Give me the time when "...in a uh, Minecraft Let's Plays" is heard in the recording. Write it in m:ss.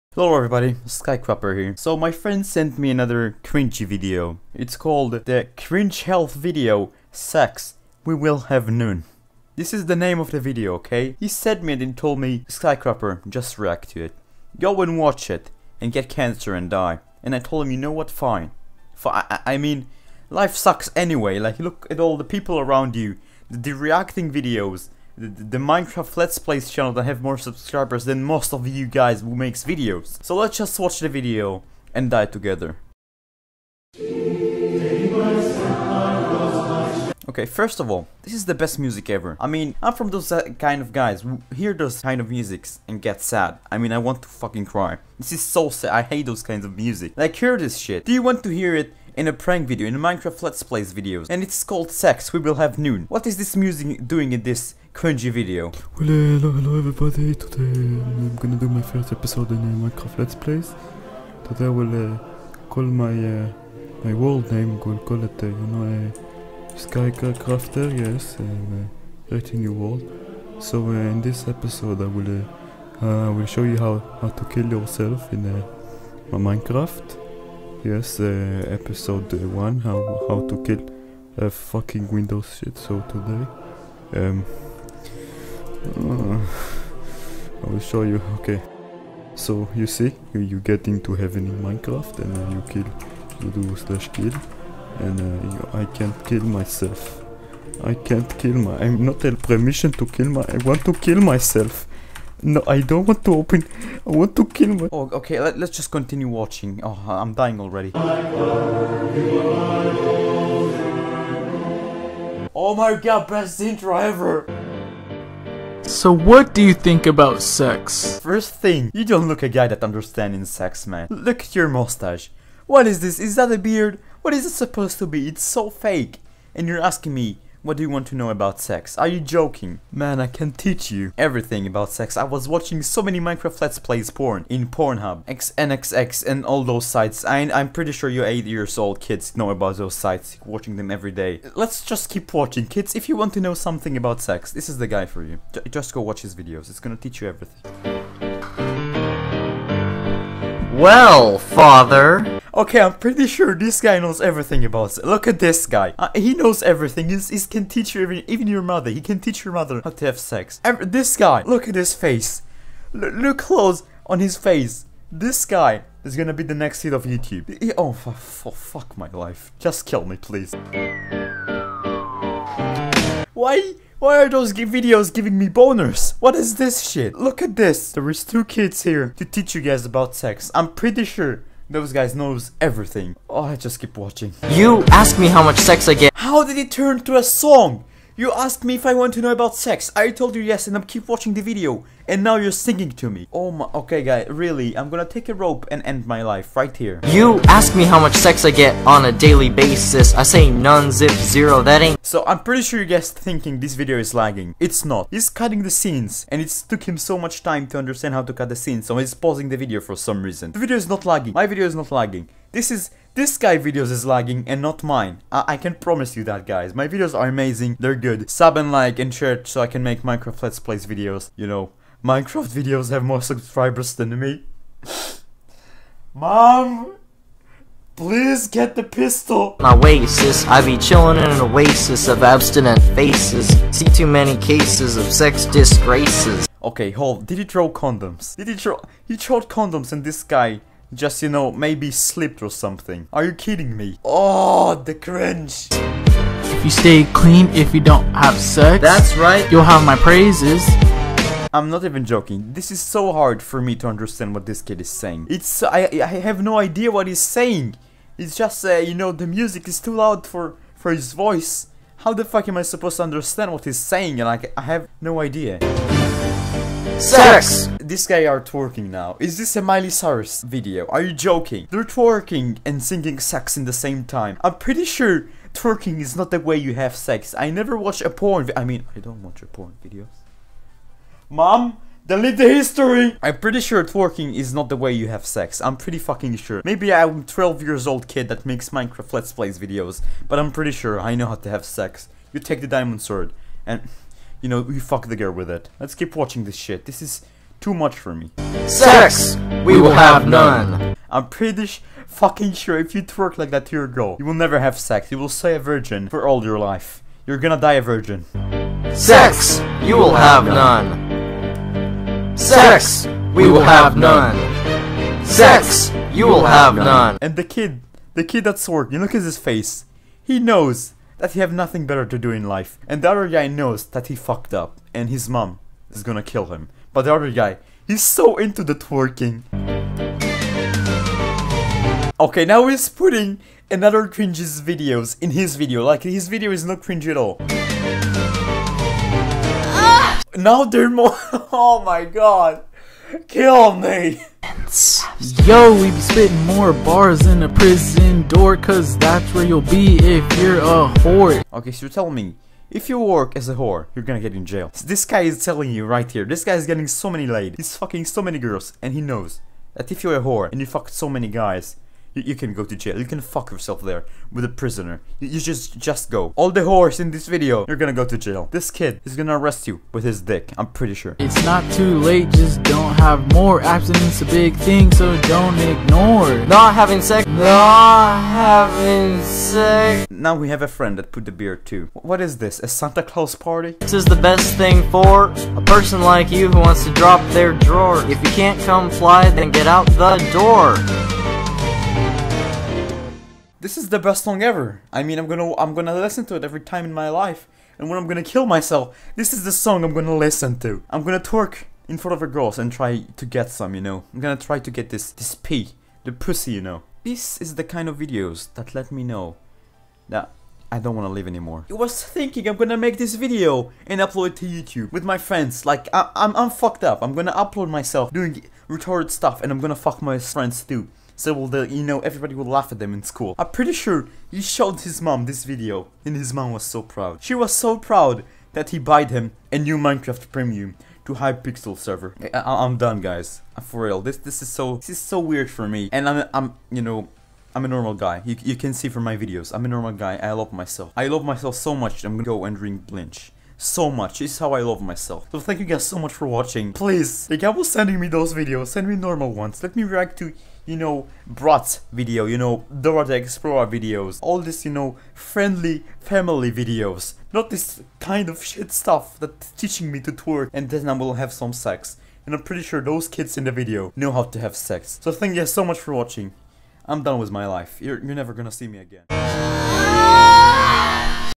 0:59.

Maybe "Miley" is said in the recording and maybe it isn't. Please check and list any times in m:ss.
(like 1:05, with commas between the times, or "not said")
4:29.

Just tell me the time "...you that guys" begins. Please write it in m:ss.
3:36.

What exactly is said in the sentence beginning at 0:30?
So let's just watch the video and die together.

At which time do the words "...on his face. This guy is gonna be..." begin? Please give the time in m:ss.
2:44.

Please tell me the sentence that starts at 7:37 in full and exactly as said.
Not this kind of shit stuff that's teaching me to twerk and then I will have some sex.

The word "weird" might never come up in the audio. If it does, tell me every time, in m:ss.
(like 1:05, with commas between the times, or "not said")
7:15.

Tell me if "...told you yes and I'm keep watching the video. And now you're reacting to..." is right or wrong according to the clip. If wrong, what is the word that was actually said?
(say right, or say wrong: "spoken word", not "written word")
wrong: "singing", not "reacting".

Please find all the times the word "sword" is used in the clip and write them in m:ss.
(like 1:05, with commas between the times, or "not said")
4:53.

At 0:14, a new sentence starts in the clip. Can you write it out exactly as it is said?
Go and watch it, and get cancer and die.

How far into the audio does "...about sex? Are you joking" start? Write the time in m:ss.
2:08.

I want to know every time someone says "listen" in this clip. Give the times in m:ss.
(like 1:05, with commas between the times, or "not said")
6:35, 6:40.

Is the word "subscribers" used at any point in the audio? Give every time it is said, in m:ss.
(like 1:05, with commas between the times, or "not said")
0:27, 3:43.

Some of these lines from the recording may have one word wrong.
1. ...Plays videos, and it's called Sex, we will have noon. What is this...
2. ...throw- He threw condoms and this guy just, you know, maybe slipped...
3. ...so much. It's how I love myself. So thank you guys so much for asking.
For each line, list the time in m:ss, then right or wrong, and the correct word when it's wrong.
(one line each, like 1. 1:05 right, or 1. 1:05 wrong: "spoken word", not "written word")
1. 0:50 right
2. 3:58 right
3. 7:23 wrong: "watching", not "asking".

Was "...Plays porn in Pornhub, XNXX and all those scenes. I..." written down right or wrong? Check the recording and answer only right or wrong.
wrong.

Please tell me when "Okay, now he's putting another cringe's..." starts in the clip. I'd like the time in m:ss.
5:32.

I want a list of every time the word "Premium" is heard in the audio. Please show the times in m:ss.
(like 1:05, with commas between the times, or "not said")
7:10.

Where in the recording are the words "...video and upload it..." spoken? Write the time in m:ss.
6:53.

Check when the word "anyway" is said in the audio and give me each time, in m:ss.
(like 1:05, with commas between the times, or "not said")
0:20.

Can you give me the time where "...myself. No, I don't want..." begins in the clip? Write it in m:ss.
1:41.